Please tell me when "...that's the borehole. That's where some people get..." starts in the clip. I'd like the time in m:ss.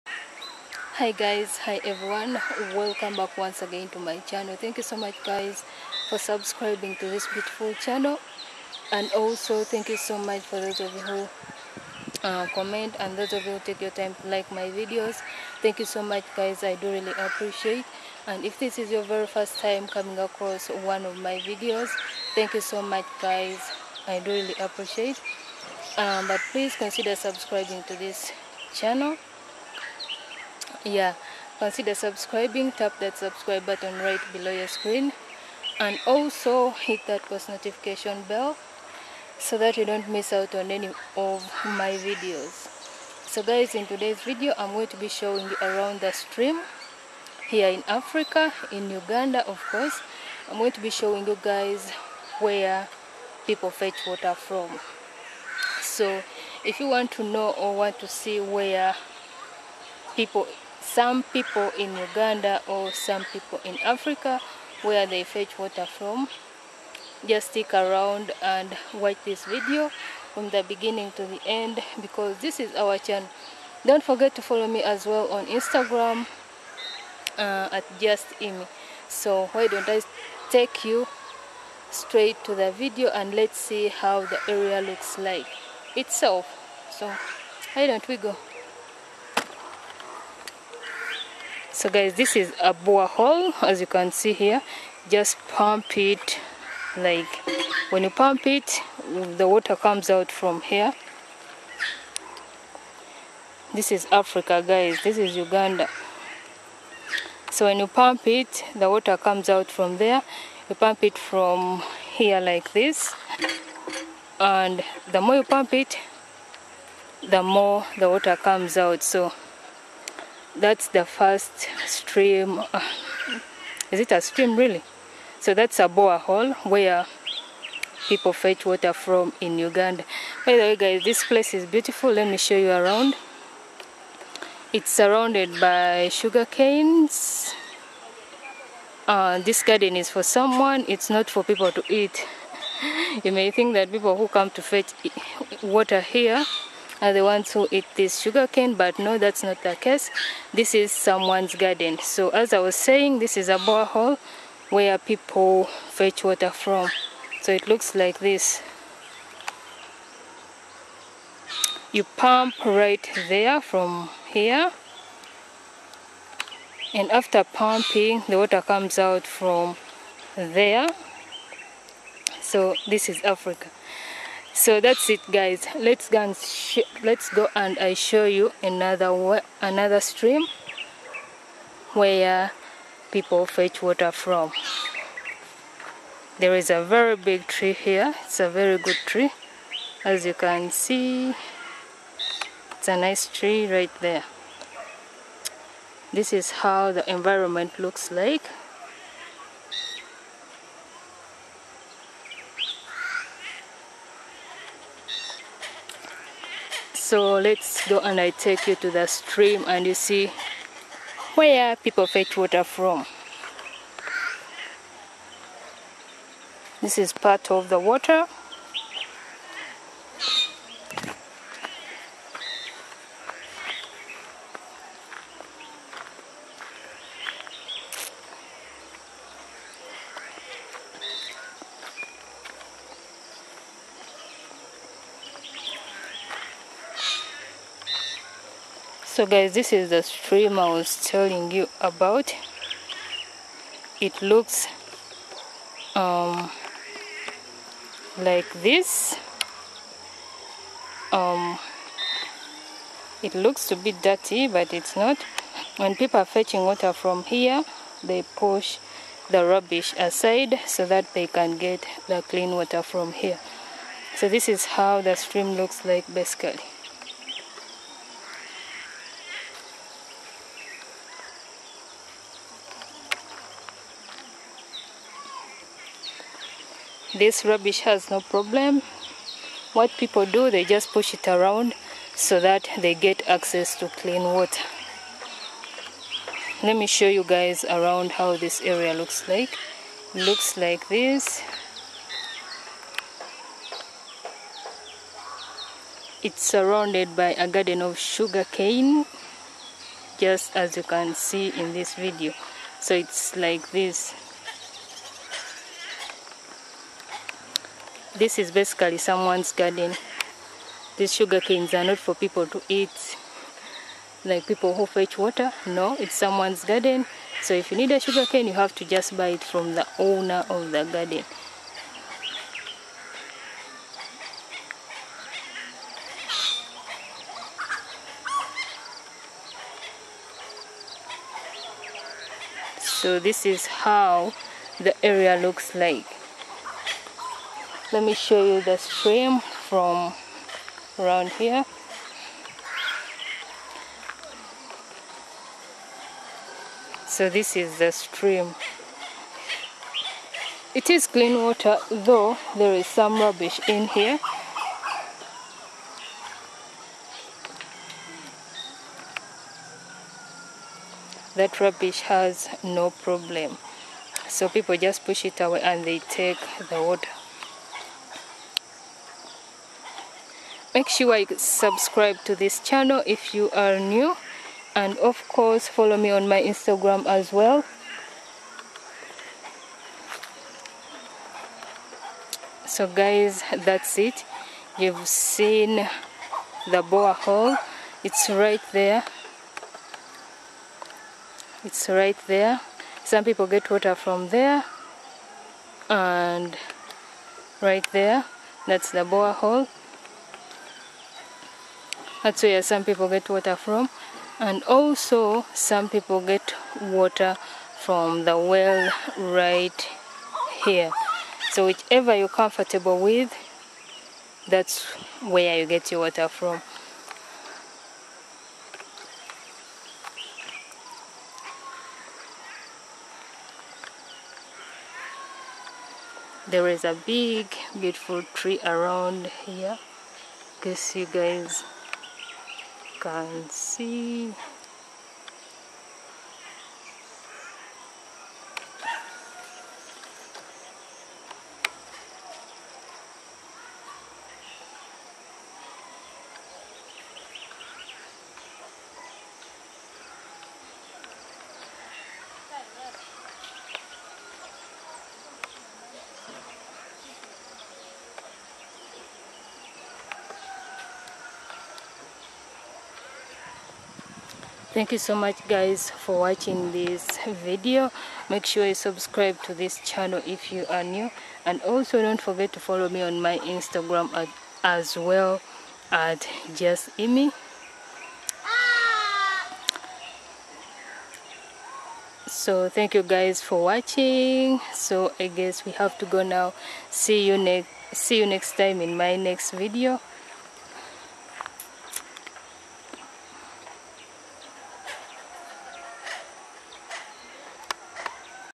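6:38.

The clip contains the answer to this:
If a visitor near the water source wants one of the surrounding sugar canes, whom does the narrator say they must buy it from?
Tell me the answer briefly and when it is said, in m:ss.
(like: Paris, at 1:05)
the owner of the garden, at 5:19.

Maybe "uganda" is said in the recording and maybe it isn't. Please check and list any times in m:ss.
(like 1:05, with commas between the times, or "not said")
0:48, 1:01, 1:45, 2:09.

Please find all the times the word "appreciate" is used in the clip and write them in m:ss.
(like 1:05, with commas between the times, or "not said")
0:17, 0:24.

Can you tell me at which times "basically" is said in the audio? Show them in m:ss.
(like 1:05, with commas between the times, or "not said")
4:26, 5:08.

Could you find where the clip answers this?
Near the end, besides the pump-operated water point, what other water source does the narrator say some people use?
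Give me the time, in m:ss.
6:48.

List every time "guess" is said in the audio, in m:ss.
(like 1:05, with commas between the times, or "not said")
7:10, 8:05.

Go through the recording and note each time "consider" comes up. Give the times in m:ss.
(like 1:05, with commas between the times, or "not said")
0:26, 0:31.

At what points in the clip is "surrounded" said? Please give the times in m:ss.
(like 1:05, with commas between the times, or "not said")
2:14, 4:56.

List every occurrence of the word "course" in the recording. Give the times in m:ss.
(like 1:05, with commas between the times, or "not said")
0:49, 6:15.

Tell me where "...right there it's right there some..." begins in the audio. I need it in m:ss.
6:28.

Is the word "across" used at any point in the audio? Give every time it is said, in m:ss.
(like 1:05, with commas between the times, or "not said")
0:20.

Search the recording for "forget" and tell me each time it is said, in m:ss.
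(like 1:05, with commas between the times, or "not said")
1:14, 7:52.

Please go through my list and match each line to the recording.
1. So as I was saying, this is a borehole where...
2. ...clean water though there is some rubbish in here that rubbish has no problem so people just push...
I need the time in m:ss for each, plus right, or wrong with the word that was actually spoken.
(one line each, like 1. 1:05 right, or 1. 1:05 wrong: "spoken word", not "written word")
1. 2:31 right
2. 5:51 right.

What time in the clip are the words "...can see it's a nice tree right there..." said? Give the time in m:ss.
3:10.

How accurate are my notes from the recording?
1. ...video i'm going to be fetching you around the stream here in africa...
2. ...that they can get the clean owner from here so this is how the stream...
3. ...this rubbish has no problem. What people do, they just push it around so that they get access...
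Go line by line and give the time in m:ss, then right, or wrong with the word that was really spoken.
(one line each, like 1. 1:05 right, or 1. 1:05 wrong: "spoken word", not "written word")
1. 0:44 wrong: "showing", not "fetching"
2. 4:20 wrong: "water", not "owner"
3. 4:37 right.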